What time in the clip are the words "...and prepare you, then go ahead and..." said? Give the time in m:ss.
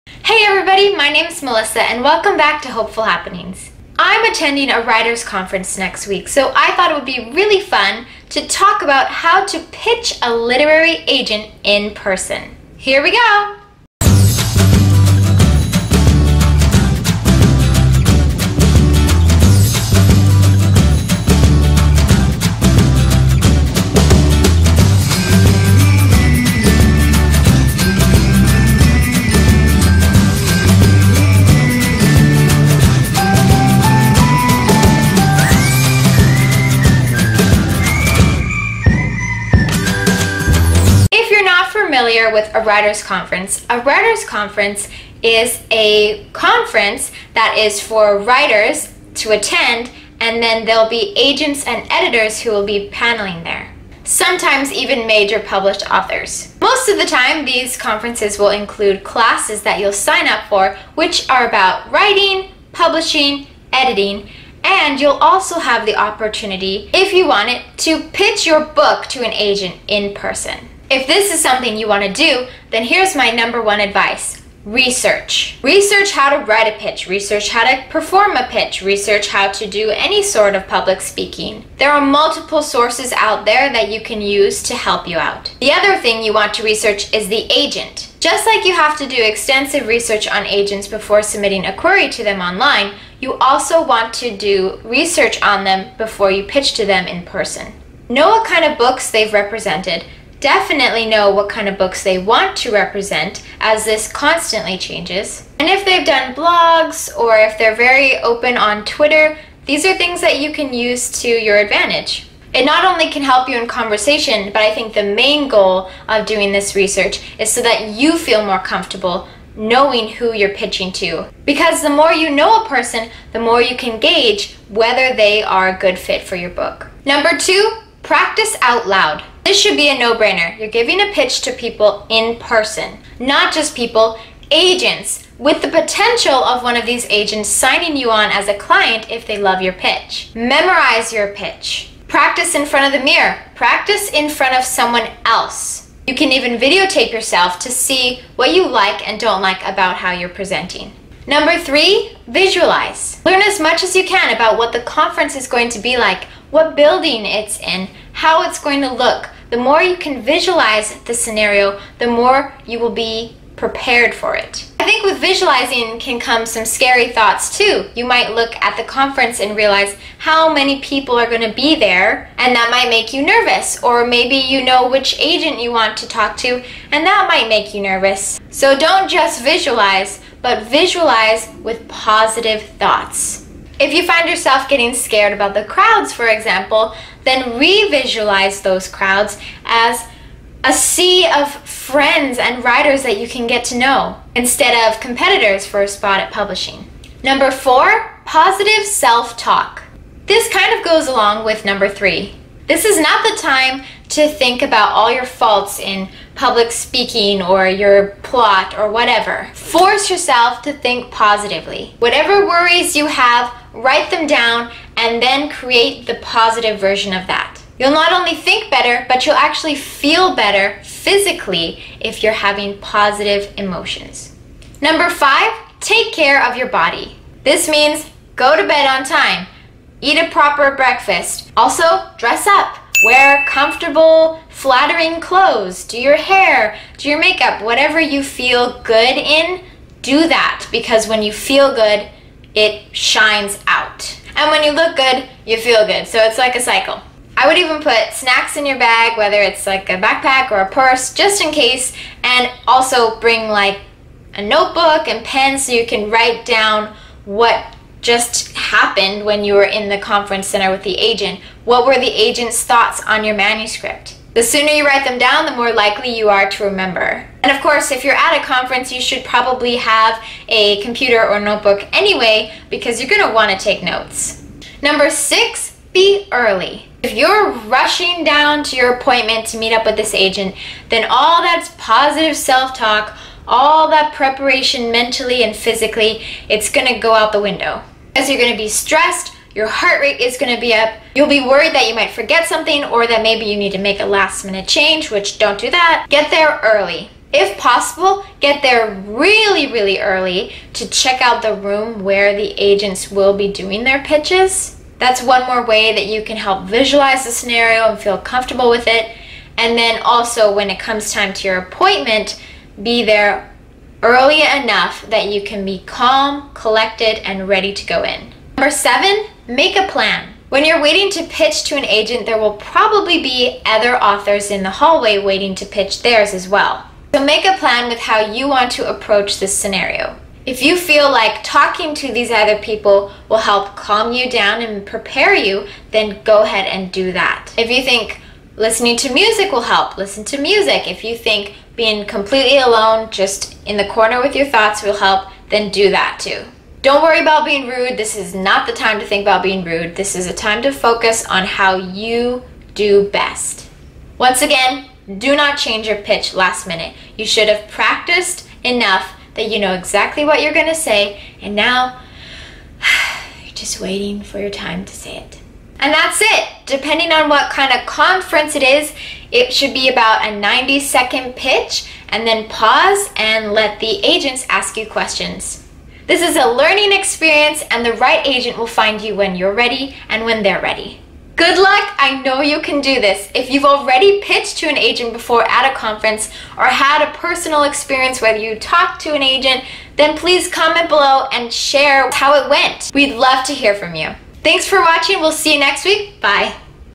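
5:34.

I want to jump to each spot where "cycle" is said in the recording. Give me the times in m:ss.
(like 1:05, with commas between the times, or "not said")
4:06.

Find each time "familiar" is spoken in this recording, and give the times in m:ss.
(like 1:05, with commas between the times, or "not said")
0:42.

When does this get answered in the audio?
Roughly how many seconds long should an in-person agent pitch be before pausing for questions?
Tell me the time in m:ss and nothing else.
6:10.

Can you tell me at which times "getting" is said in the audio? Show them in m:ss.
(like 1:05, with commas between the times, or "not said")
3:04.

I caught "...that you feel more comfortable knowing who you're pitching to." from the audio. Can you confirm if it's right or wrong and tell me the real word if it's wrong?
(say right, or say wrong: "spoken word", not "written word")
right.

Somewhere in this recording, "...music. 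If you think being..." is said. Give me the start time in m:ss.
5:40.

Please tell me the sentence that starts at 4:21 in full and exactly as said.
What were the agent's thoughts on your manuscript?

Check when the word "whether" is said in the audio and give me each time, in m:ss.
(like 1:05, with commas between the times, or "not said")
2:04, 4:09, 6:28.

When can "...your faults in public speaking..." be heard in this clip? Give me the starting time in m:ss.
3:25.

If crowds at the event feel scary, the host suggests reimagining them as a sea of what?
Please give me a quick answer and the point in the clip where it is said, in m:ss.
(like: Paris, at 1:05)
friends and writers, at 3:11.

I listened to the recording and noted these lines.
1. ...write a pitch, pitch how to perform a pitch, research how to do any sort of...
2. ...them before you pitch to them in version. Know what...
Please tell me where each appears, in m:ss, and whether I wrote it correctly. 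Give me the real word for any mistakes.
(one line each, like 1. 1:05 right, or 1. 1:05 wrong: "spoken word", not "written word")
1. 1:16 wrong: "research", not "pitch"
2. 1:35 wrong: "person", not "version".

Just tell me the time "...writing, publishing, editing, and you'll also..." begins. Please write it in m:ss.
1:01.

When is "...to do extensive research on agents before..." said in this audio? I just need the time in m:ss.
1:28.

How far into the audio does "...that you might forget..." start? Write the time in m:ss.
4:51.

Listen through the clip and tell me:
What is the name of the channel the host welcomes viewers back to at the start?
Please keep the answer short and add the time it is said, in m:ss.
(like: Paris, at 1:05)
Hopeful Happenings, at 0:02.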